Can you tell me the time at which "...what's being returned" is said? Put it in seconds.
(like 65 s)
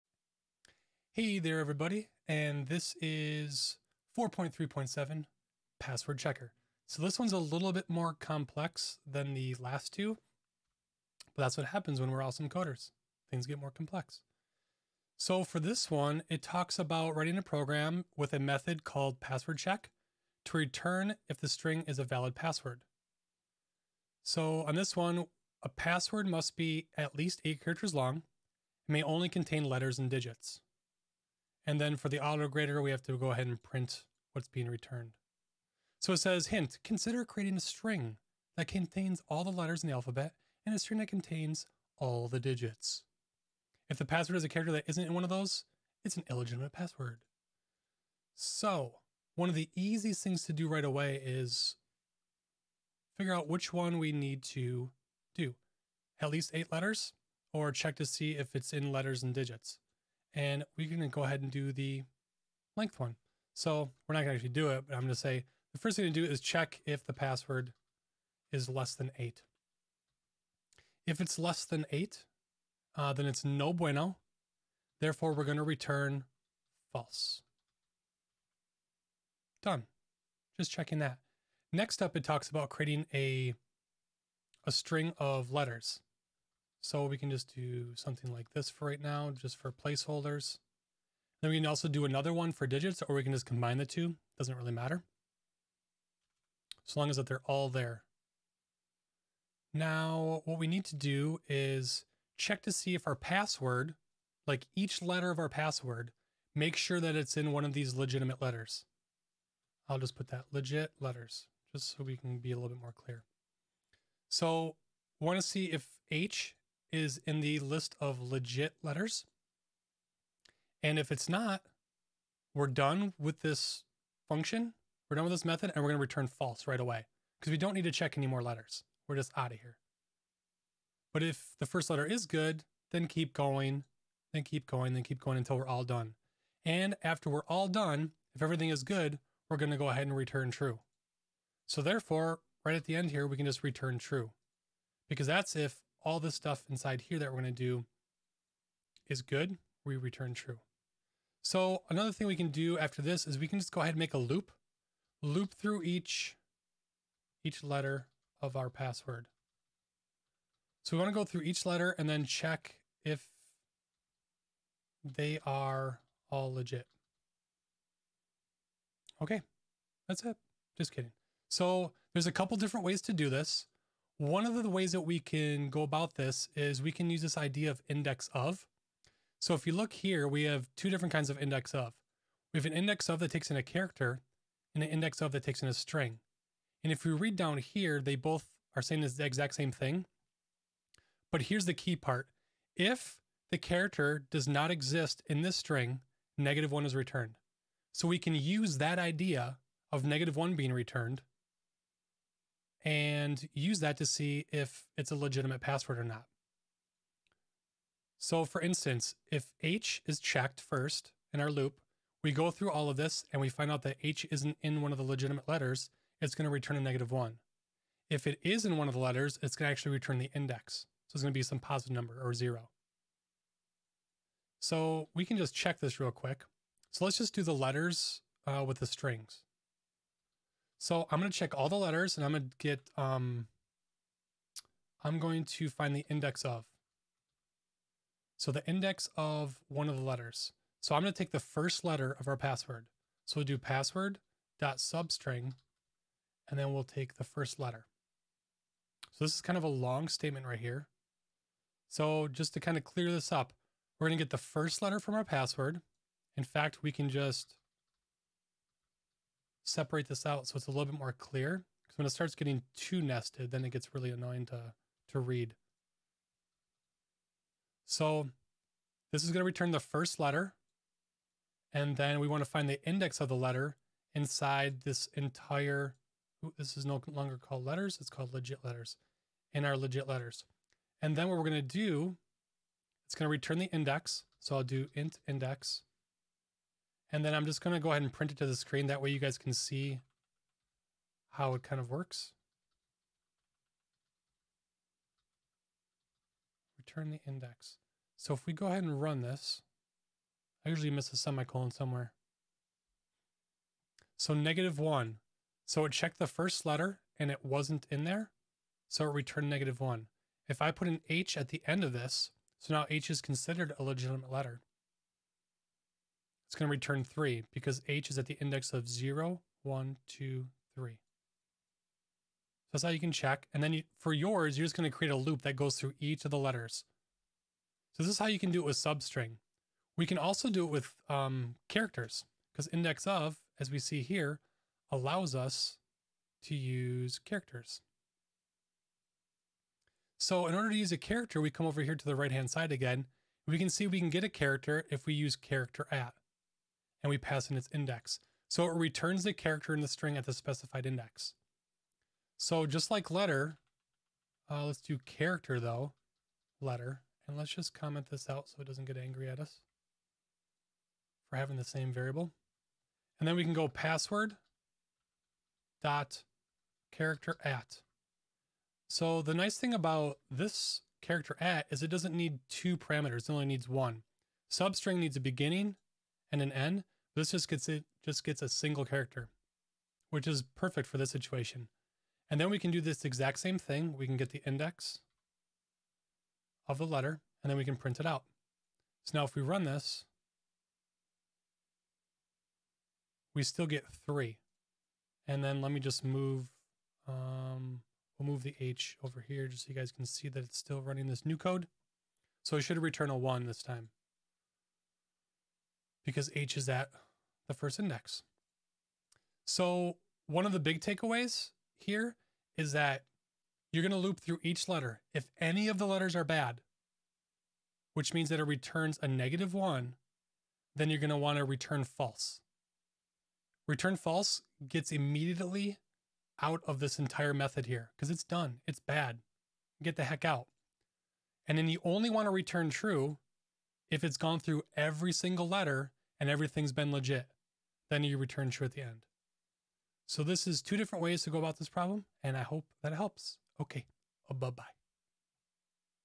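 34 s.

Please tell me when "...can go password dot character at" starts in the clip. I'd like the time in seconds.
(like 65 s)
363 s.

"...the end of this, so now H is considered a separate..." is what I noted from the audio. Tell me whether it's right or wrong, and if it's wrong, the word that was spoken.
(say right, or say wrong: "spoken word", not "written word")
wrong: "legitimate", not "separate".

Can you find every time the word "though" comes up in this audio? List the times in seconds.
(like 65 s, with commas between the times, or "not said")
355 s.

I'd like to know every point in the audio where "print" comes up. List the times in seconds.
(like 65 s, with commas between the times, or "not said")
33 s, 288 s, 387 s.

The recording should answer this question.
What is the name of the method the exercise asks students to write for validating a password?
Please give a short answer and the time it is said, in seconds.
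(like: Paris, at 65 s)
password check, at 19 s.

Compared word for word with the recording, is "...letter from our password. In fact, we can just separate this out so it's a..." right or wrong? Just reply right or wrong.
right.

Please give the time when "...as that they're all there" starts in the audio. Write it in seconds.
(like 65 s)
97 s.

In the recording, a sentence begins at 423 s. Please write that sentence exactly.
Return false gets immediately out of this entire method here because it's done.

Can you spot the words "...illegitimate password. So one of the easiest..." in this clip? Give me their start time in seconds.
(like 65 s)
46 s.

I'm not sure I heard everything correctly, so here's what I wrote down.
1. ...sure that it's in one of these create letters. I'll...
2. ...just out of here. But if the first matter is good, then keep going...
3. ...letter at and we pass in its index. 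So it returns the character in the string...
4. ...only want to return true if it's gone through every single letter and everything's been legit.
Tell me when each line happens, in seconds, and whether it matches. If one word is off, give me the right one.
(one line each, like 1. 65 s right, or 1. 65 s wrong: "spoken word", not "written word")
1. 106 s wrong: "legitimate", not "create"
2. 129 s wrong: "letter", not "matter"
3. 345 s wrong: "character", not "letter"
4. 431 s right.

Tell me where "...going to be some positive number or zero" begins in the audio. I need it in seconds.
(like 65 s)
221 s.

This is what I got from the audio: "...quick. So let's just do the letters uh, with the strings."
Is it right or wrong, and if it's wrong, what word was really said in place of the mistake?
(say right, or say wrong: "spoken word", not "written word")
right.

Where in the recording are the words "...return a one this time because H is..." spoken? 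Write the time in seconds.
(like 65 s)
402 s.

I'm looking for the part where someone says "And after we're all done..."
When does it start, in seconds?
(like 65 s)
136 s.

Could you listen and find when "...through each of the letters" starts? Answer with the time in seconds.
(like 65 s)
325 s.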